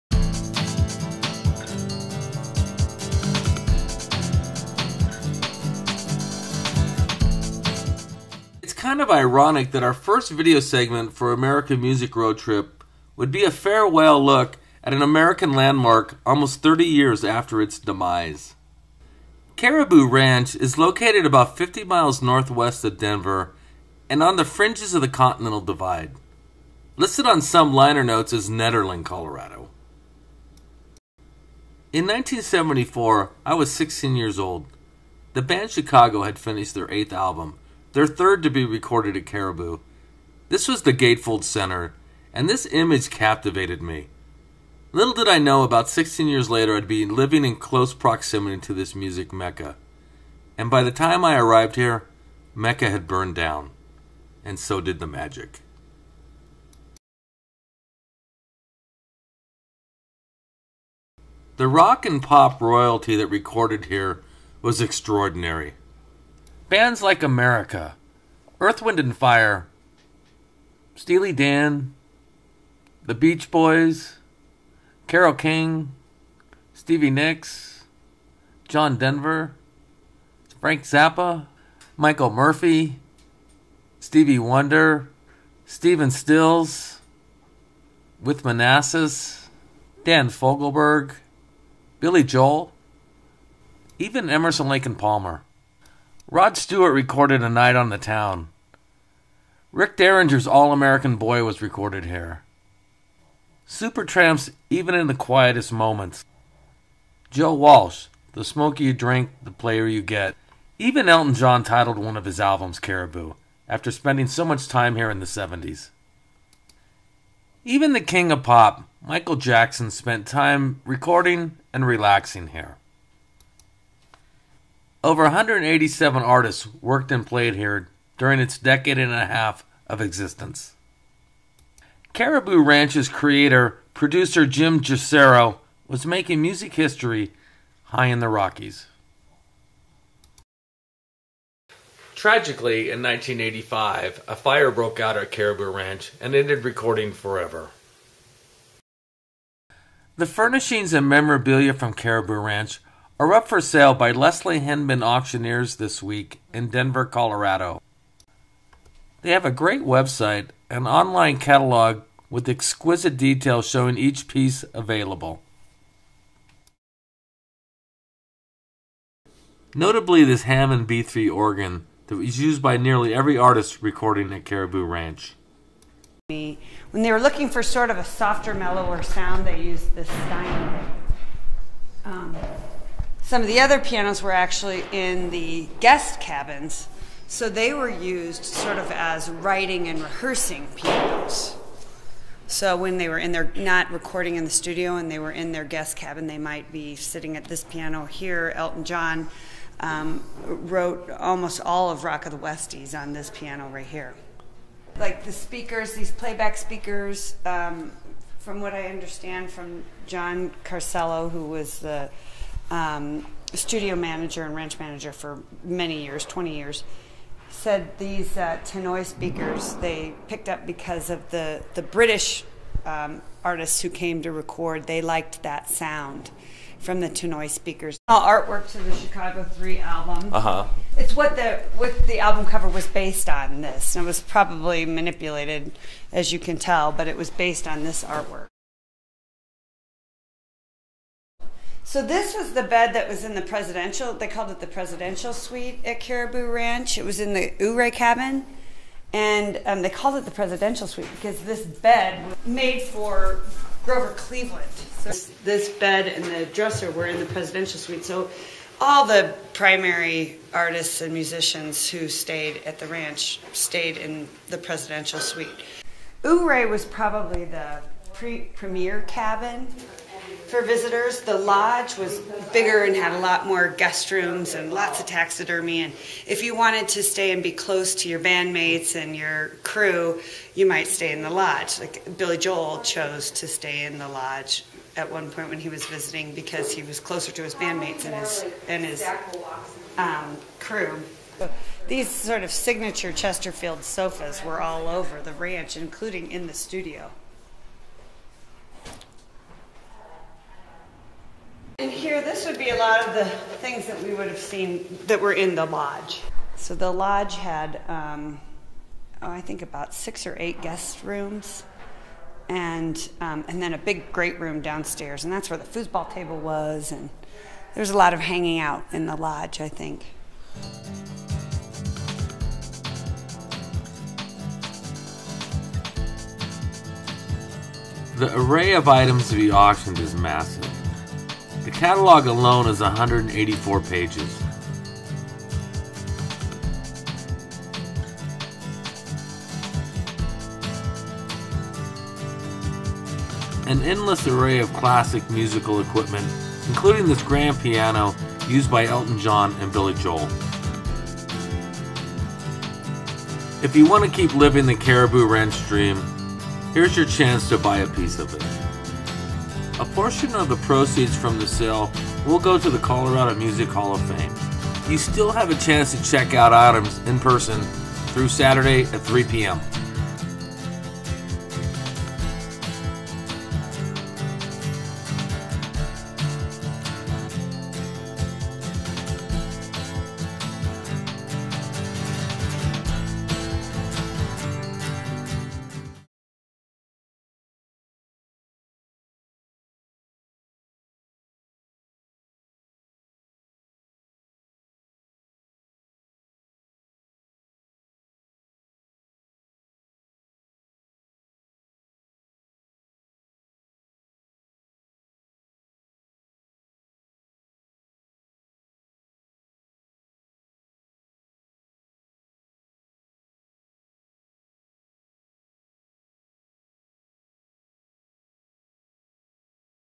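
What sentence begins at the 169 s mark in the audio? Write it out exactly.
Notably, this Hammond B3 organ that was used by nearly every artist recording at Caribou Ranch.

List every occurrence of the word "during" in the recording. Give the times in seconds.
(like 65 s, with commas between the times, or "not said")
128 s.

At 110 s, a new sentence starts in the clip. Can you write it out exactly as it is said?
Even Elton John titled one of his albums Caribou, after spending so much time here in the 70s.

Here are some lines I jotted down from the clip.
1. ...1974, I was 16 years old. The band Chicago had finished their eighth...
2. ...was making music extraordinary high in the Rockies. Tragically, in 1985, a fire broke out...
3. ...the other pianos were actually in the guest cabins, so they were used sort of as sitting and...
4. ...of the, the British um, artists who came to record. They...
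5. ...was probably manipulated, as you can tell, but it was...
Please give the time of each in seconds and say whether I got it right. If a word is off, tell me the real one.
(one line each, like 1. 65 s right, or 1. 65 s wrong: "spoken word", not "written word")
1. 32 s right
2. 135 s wrong: "history", not "extraordinary"
3. 183 s wrong: "writing", not "sitting"
4. 221 s right
5. 234 s right.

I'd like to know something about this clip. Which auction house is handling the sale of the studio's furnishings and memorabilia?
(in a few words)
Leslie Hindman Auctioneers.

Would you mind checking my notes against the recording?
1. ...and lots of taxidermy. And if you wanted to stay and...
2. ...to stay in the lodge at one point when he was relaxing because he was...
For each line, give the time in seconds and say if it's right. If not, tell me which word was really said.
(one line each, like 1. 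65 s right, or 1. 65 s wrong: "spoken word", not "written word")
1. 274 s right
2. 283 s wrong: "visiting", not "relaxing".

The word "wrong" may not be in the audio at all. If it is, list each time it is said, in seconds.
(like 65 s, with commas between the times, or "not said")
not said.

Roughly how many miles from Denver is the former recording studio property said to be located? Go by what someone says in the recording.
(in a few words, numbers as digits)
50.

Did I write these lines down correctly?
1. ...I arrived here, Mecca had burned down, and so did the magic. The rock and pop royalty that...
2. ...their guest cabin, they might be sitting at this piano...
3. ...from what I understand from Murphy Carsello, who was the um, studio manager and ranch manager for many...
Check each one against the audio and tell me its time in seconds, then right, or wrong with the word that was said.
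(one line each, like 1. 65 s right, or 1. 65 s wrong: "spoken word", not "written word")
1. 51 s right
2. 195 s right
3. 208 s wrong: "John", not "Murphy".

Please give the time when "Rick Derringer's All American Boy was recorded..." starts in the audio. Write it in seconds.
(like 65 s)
99 s.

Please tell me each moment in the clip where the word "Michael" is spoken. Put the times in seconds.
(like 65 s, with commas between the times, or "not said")
81 s, 119 s.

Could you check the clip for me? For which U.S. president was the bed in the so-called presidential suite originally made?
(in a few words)
Grover Cleveland.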